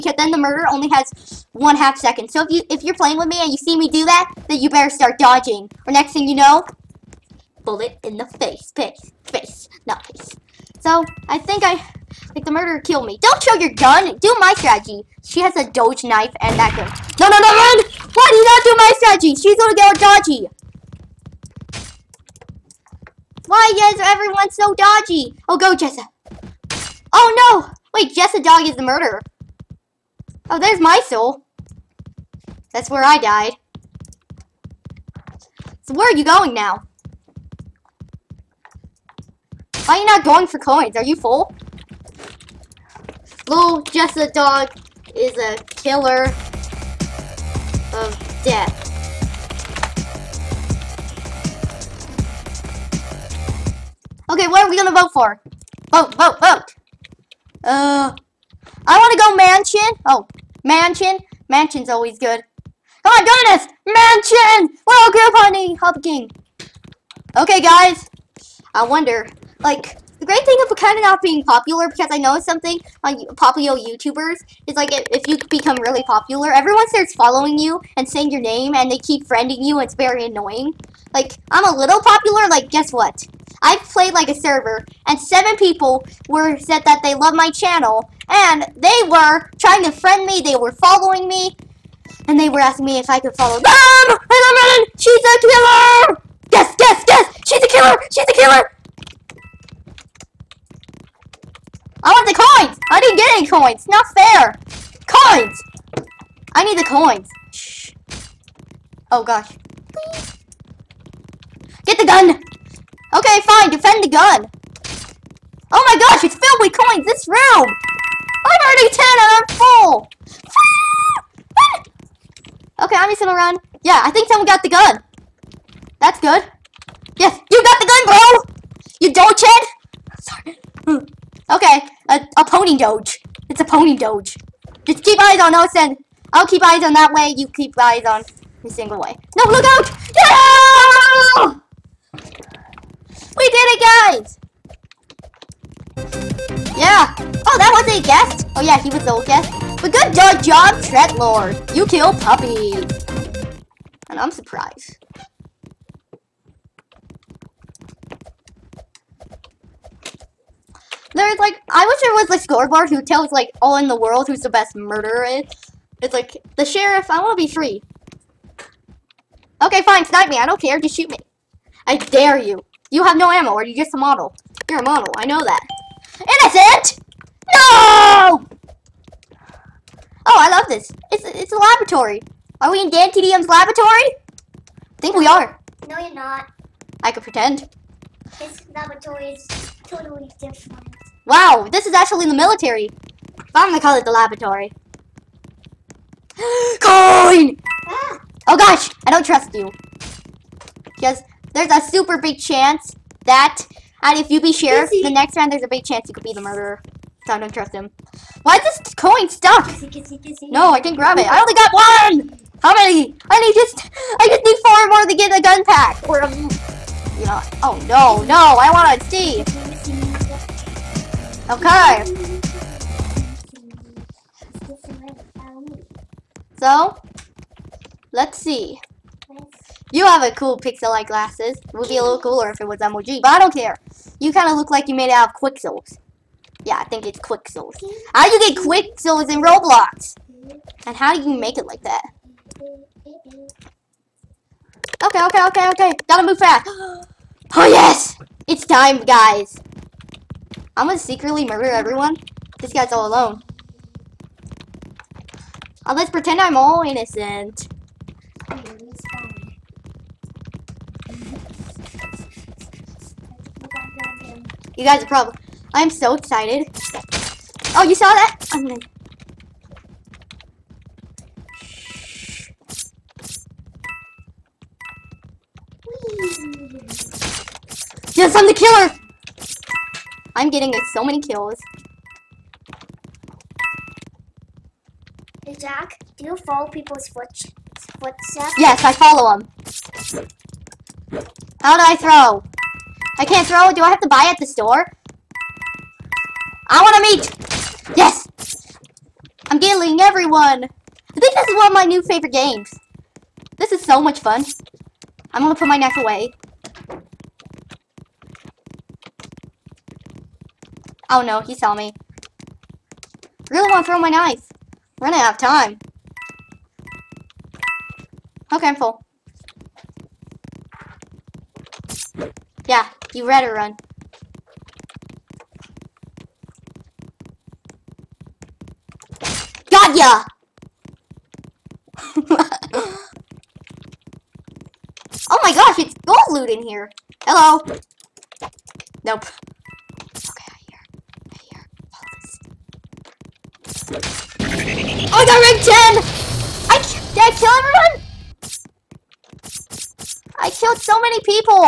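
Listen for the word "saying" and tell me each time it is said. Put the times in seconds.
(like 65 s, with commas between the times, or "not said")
78 s.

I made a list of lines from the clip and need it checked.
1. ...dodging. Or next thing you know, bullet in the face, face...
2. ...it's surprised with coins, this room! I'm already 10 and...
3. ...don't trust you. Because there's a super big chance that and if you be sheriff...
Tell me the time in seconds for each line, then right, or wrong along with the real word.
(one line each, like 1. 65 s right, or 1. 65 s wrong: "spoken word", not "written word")
1. 5 s right
2. 116 s wrong: "filled", not "surprised"
3. 199 s right.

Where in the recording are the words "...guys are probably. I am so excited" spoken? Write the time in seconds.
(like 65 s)
264 s.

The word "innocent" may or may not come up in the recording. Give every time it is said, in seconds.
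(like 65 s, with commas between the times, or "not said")
176 s, 256 s.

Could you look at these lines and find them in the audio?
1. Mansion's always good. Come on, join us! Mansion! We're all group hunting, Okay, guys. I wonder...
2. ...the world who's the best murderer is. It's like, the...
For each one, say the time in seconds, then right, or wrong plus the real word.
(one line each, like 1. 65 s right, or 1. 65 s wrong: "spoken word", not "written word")
1. 61 s right
2. 163 s right.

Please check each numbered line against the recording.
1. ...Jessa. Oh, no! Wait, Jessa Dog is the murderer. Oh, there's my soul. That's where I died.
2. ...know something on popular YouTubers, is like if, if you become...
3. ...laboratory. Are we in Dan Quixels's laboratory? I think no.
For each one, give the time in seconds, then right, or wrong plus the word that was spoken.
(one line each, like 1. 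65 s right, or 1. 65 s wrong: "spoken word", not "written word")
1. 25 s right
2. 72 s right
3. 181 s wrong: "TDM", not "Quixels".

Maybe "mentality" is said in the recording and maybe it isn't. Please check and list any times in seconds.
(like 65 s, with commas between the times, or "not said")
not said.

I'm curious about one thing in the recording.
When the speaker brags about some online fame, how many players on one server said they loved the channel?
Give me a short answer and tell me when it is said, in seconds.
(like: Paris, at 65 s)
7, at 85 s.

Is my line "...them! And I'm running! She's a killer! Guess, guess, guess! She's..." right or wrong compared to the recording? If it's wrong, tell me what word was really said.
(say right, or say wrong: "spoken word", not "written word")
right.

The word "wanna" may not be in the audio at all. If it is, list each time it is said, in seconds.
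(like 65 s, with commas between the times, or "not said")
58 s, 313 s.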